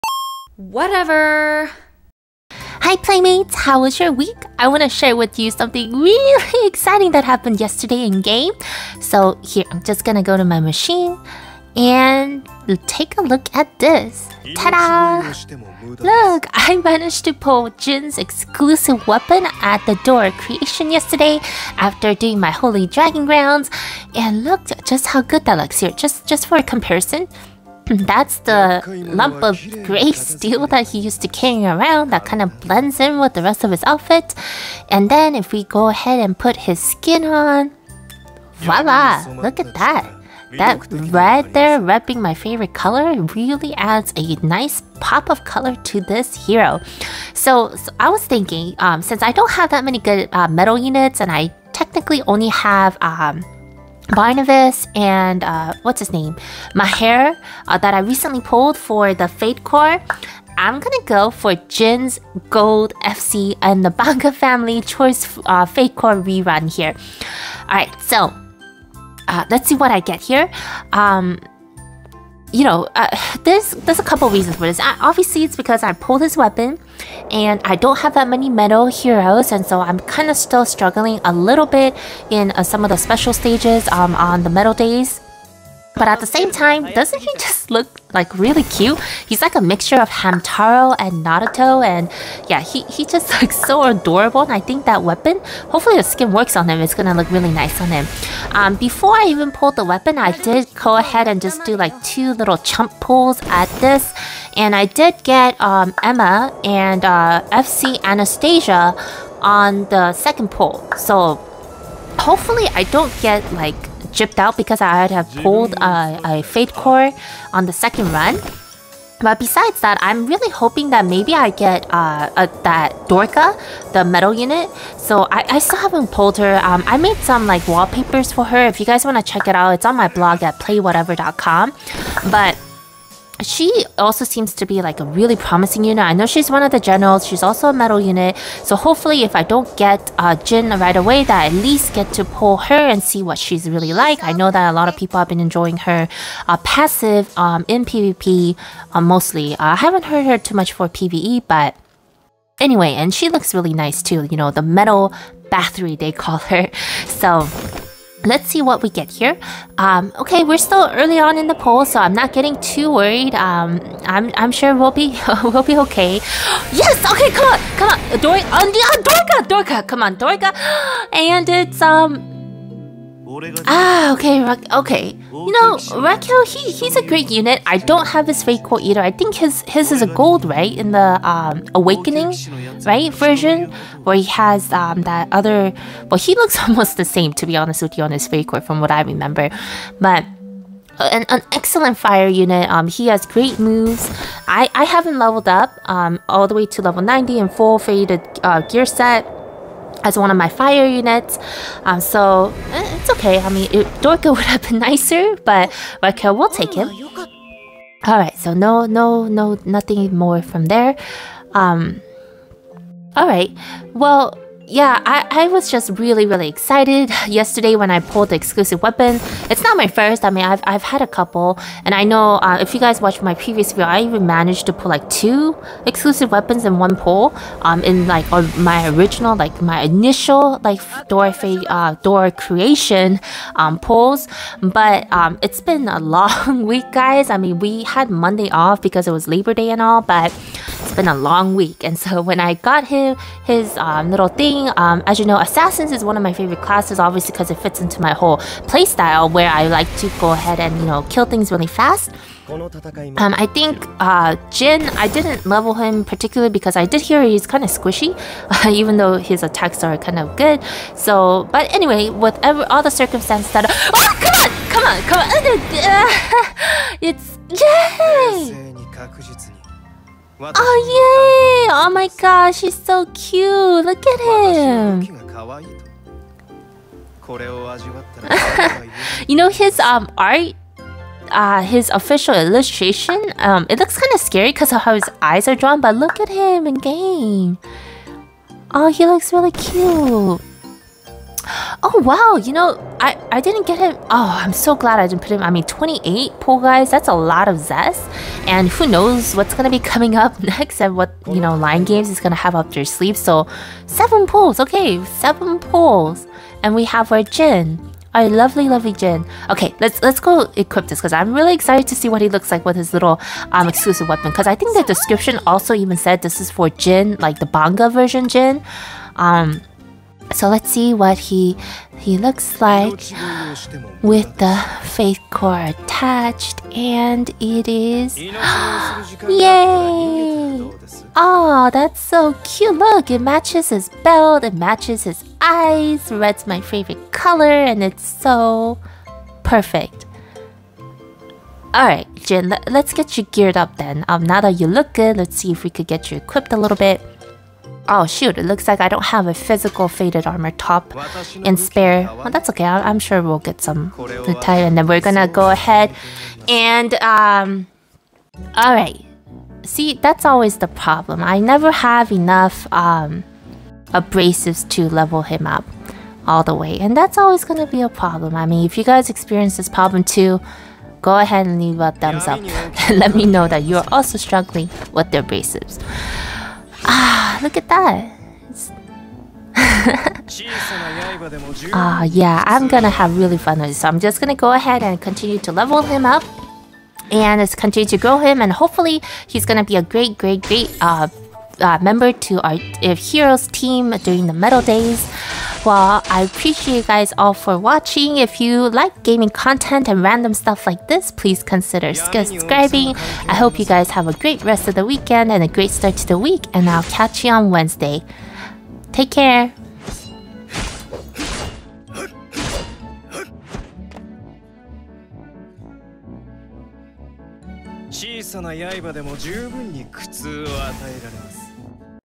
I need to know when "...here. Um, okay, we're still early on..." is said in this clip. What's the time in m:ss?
2:39.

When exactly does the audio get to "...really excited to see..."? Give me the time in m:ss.
5:11.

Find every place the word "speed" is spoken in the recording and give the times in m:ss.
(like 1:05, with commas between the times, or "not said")
not said.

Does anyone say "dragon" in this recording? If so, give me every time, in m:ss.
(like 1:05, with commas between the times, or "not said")
0:22.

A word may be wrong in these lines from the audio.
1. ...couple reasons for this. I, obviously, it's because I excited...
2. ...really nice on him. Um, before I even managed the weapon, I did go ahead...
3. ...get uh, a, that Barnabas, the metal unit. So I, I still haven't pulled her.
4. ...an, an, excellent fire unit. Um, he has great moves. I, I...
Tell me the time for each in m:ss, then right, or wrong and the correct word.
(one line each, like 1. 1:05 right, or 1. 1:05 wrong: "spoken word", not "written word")
1. 1:14 wrong: "pulled", not "excited"
2. 1:37 wrong: "pulled", not "managed"
3. 2:01 wrong: "Dorka", not "Barnabas"
4. 3:11 right.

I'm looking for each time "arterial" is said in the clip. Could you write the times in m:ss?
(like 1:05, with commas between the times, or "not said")
not said.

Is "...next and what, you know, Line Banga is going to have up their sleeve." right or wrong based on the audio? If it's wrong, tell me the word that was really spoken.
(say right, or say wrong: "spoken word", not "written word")
wrong: "Games", not "Banga".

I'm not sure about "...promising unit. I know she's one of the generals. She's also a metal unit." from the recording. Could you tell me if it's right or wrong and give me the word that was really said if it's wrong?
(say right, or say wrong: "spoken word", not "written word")
right.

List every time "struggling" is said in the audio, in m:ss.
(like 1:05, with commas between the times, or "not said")
1:20, 6:14.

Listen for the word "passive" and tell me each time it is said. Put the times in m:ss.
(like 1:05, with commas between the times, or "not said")
2:26.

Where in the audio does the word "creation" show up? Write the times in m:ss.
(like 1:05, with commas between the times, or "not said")
0:20, 3:52.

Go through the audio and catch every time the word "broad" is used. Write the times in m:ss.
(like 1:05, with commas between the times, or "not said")
not said.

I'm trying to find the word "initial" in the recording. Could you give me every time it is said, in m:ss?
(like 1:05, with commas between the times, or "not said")
3:49.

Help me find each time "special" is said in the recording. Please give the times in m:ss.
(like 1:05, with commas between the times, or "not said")
1:22.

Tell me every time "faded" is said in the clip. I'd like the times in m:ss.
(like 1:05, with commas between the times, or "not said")
3:17, 5:49.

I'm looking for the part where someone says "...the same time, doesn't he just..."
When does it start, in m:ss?
1:26.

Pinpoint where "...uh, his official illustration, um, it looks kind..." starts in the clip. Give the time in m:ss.
4:41.